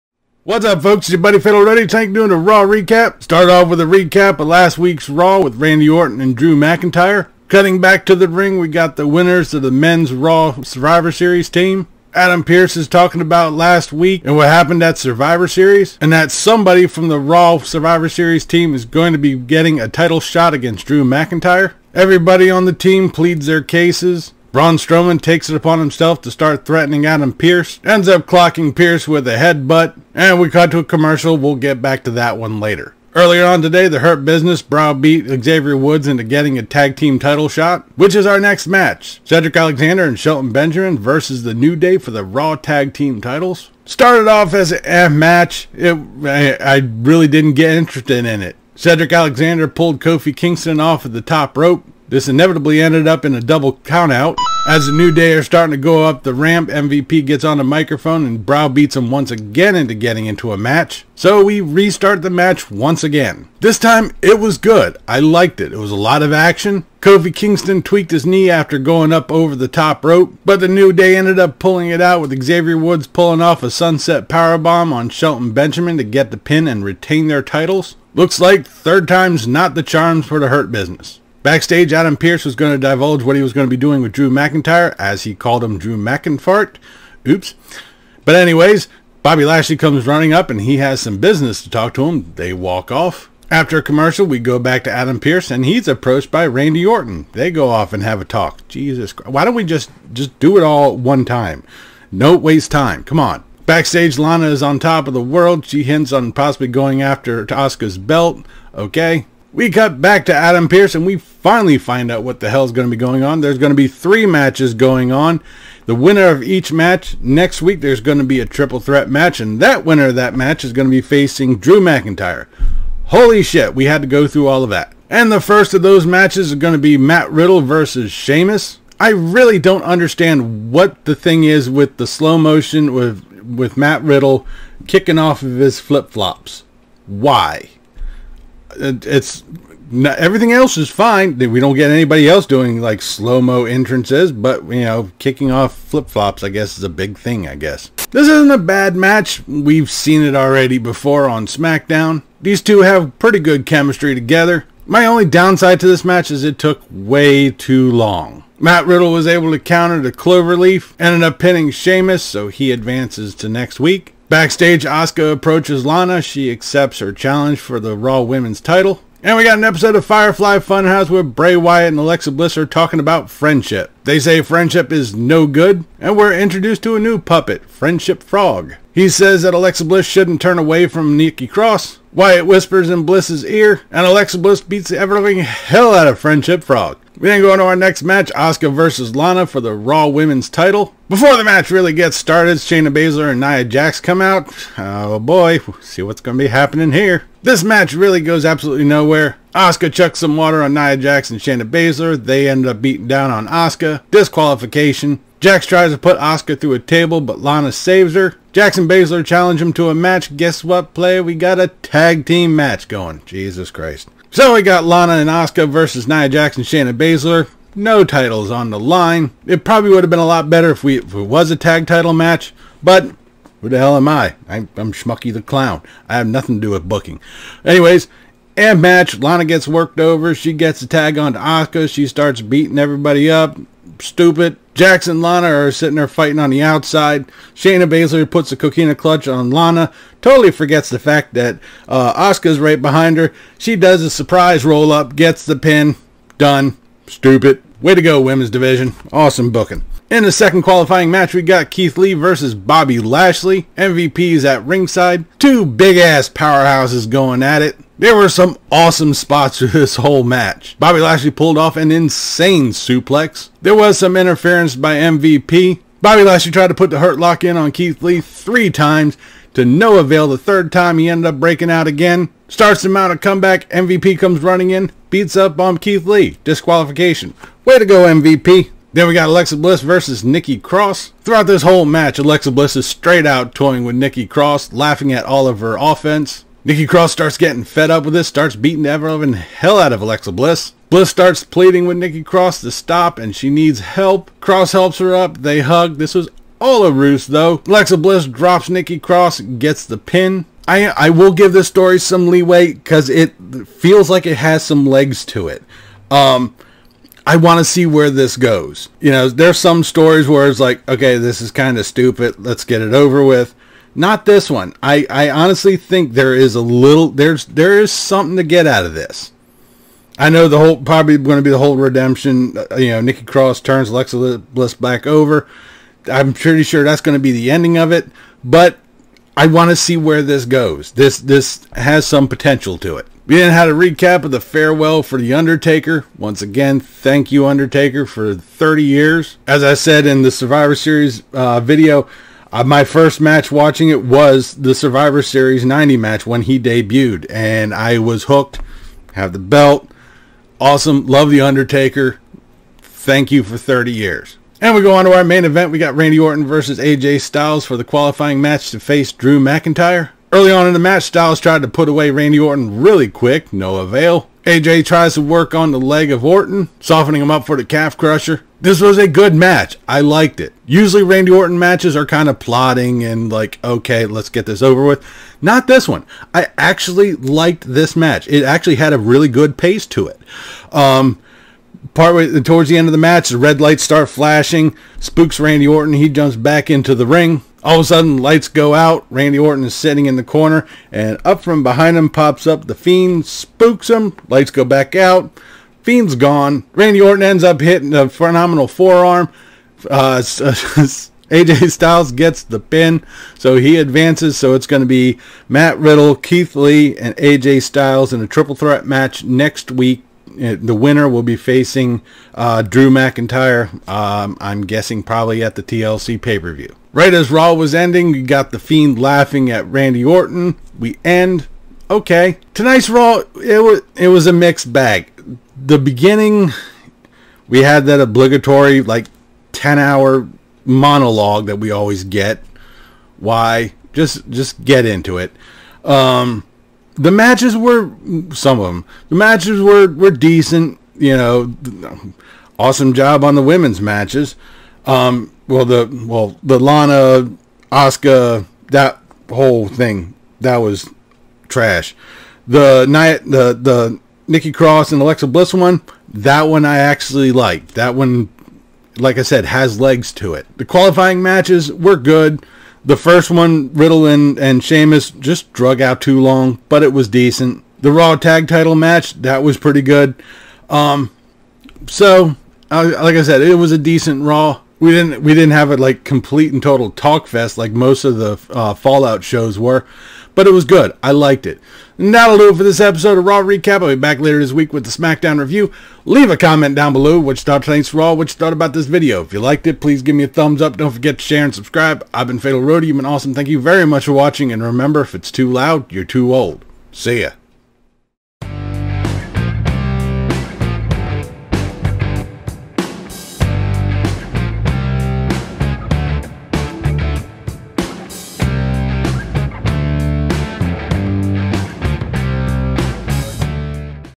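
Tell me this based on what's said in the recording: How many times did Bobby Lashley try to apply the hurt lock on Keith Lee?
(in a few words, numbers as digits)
3.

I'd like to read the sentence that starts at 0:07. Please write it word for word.
Cutting back to the ring, we got the winners of the men's Raw Survivor Series team.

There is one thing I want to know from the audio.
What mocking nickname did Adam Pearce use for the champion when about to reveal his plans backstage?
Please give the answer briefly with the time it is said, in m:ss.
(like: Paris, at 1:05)
Drew McInfart, at 1:25.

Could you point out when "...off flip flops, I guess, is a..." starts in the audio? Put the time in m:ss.
2:25.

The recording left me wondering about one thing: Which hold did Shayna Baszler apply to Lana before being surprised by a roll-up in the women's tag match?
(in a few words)
Coquina clutch.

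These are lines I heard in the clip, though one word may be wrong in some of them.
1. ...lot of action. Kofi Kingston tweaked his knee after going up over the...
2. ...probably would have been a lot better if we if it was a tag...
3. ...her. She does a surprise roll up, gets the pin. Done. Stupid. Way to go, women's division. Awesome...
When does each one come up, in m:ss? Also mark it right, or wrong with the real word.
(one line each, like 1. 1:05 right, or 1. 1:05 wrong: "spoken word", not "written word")
1. 1:05 right
2. 3:39 right
3. 4:03 right.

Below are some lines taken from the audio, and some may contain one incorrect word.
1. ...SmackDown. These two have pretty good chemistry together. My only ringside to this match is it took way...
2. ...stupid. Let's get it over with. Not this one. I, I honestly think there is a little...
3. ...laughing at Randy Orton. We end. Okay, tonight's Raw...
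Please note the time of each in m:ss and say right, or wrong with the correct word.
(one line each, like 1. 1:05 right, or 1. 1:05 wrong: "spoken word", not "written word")
1. 2:31 wrong: "downside", not "ringside"
2. 5:11 right
3. 6:59 right.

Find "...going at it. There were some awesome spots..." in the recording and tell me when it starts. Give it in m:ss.
4:17.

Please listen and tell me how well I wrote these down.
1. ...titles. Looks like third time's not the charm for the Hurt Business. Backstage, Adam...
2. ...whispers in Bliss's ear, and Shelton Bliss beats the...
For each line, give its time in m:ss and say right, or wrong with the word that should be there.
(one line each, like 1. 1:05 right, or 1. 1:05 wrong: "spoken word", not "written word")
1. 1:17 right
2. 3:02 wrong: "Alexa", not "Shelton".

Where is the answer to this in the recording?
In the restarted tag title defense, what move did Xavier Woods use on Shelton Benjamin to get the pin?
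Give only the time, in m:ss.
1:13.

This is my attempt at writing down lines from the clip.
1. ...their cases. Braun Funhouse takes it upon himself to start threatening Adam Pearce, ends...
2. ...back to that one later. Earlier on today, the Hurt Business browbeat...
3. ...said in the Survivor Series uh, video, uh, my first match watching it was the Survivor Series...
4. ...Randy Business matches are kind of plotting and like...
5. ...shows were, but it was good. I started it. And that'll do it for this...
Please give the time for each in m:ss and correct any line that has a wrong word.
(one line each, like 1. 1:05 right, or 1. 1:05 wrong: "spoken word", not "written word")
1. 0:23 wrong: "Strowman", not "Funhouse"
2. 0:31 right
3. 5:39 right
4. 6:11 wrong: "Orton", not "Business"
5. 7:59 wrong: "liked", not "started".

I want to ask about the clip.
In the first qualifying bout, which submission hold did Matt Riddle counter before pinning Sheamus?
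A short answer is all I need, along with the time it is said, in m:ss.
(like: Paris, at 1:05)
The Cloverleaf, at 2:40.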